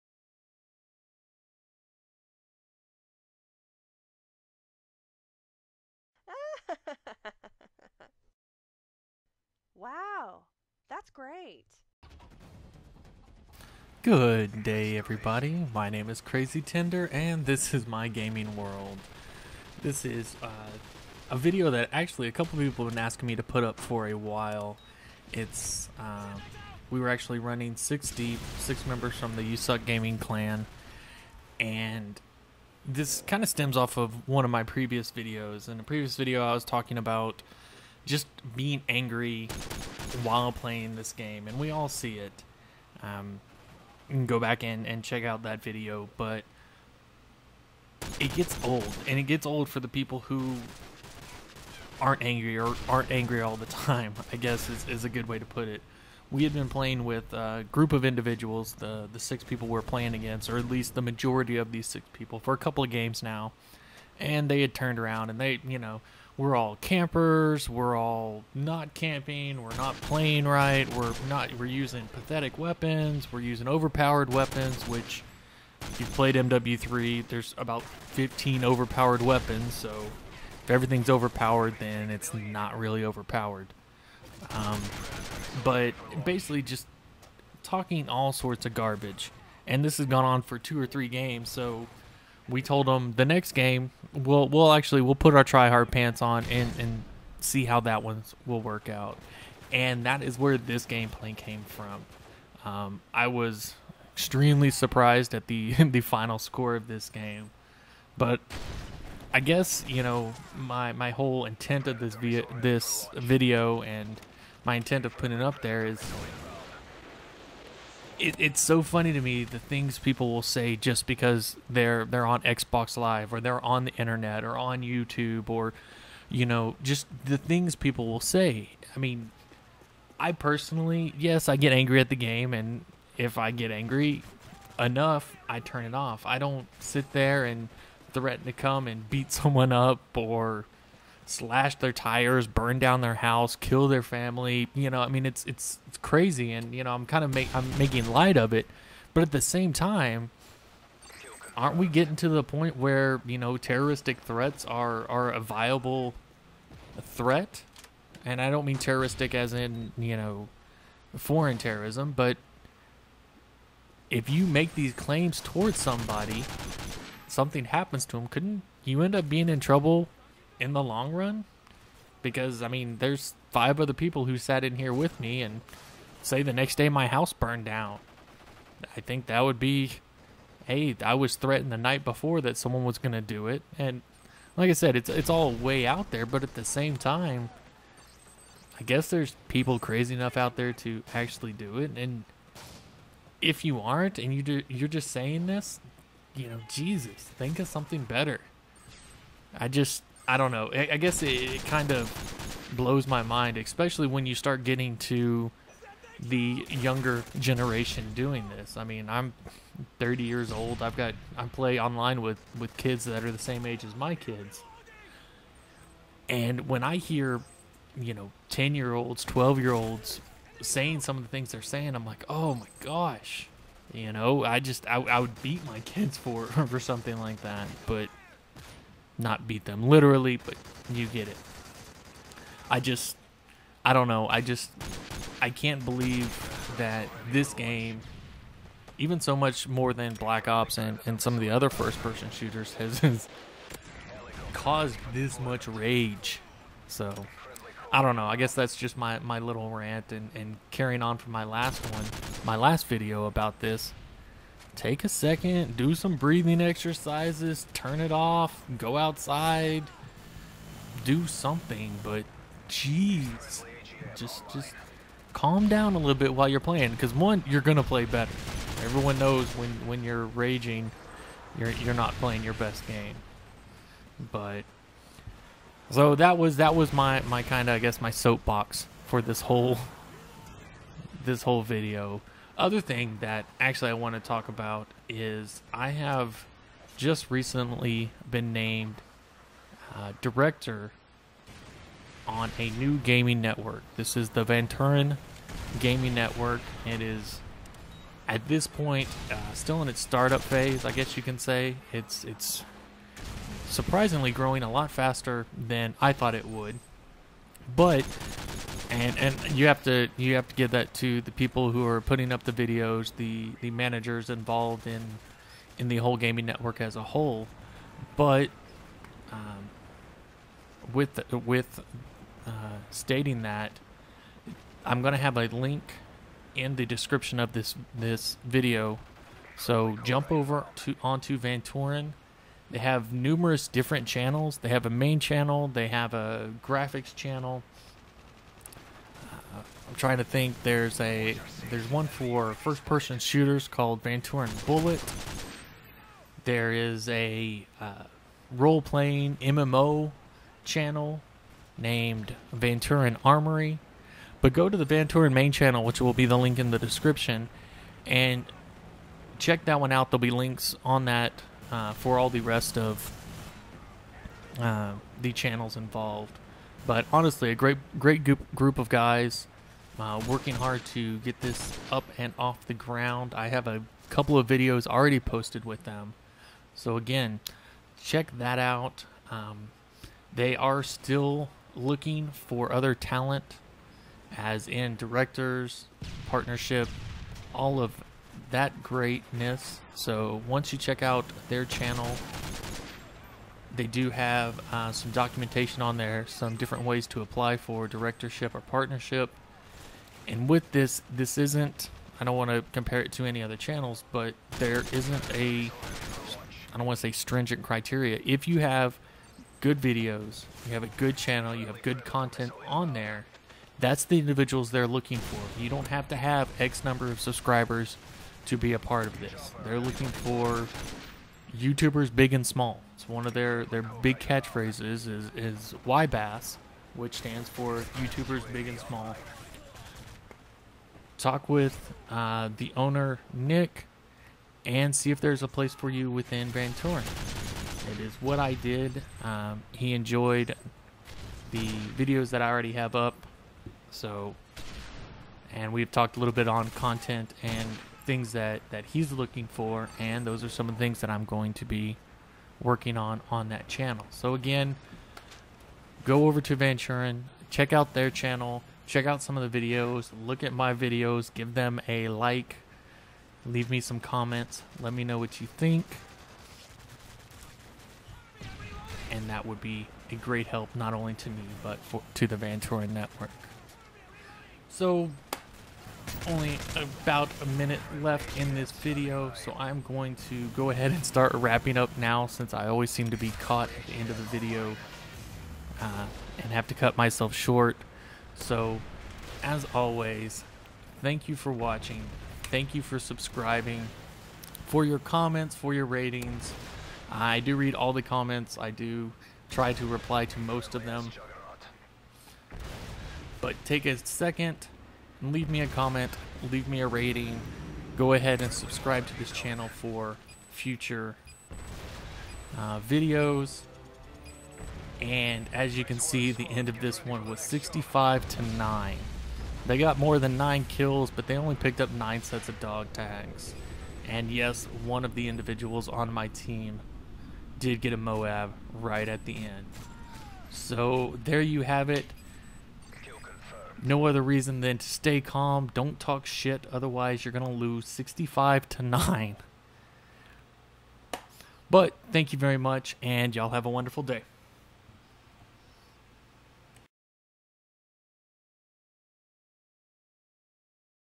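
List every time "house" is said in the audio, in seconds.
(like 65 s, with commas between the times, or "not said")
143 s, 177 s.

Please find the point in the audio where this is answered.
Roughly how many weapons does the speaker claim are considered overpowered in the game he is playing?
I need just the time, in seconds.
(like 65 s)
77 s.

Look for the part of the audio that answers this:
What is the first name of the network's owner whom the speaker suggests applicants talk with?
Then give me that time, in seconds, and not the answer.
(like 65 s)
433 s.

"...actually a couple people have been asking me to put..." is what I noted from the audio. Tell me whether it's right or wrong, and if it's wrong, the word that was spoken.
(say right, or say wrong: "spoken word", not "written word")
right.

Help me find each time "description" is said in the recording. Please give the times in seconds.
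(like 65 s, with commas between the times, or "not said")
326 s, 356 s.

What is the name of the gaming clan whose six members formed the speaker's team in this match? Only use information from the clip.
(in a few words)
USUK Gaming.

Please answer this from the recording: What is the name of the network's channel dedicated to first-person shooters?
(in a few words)
Vanturan Bullet.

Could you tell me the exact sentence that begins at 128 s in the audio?
I mean, I personally, yes, I get angry at the game, and if I get angry enough, I turn it off.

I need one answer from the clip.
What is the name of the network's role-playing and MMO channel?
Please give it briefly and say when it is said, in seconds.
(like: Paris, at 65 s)
Vanturan Armory, at 352 s.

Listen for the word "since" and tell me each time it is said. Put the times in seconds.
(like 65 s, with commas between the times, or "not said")
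482 s.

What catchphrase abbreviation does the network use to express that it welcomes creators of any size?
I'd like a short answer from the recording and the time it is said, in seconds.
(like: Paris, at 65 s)
YBass, at 425 s.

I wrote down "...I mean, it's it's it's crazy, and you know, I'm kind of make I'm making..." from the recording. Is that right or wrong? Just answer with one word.
right.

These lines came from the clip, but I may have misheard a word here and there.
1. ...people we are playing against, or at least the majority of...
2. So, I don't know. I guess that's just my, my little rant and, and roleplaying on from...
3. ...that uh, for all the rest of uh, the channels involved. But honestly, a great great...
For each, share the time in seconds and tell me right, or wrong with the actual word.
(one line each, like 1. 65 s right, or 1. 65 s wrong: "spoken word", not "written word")
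1. 59 s right
2. 246 s wrong: "carrying", not "roleplaying"
3. 361 s right.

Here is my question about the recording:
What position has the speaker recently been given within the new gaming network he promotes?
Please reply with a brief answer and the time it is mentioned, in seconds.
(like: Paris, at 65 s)
Director, at 290 s.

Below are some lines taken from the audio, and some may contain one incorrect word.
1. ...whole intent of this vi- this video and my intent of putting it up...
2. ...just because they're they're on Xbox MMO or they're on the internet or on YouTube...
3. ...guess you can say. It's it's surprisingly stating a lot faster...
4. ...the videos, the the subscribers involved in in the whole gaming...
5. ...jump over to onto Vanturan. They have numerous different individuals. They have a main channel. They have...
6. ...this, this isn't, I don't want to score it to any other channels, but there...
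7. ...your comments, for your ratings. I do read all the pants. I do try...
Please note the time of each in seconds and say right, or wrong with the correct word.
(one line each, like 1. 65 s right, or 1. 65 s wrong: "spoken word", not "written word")
1. 111 s right
2. 120 s wrong: "Live", not "MMO"
3. 300 s wrong: "growing", not "stating"
4. 312 s wrong: "managers", not "subscribers"
5. 330 s wrong: "channels", not "individuals"
6. 400 s wrong: "compare", not "score"
7. 494 s wrong: "comments", not "pants".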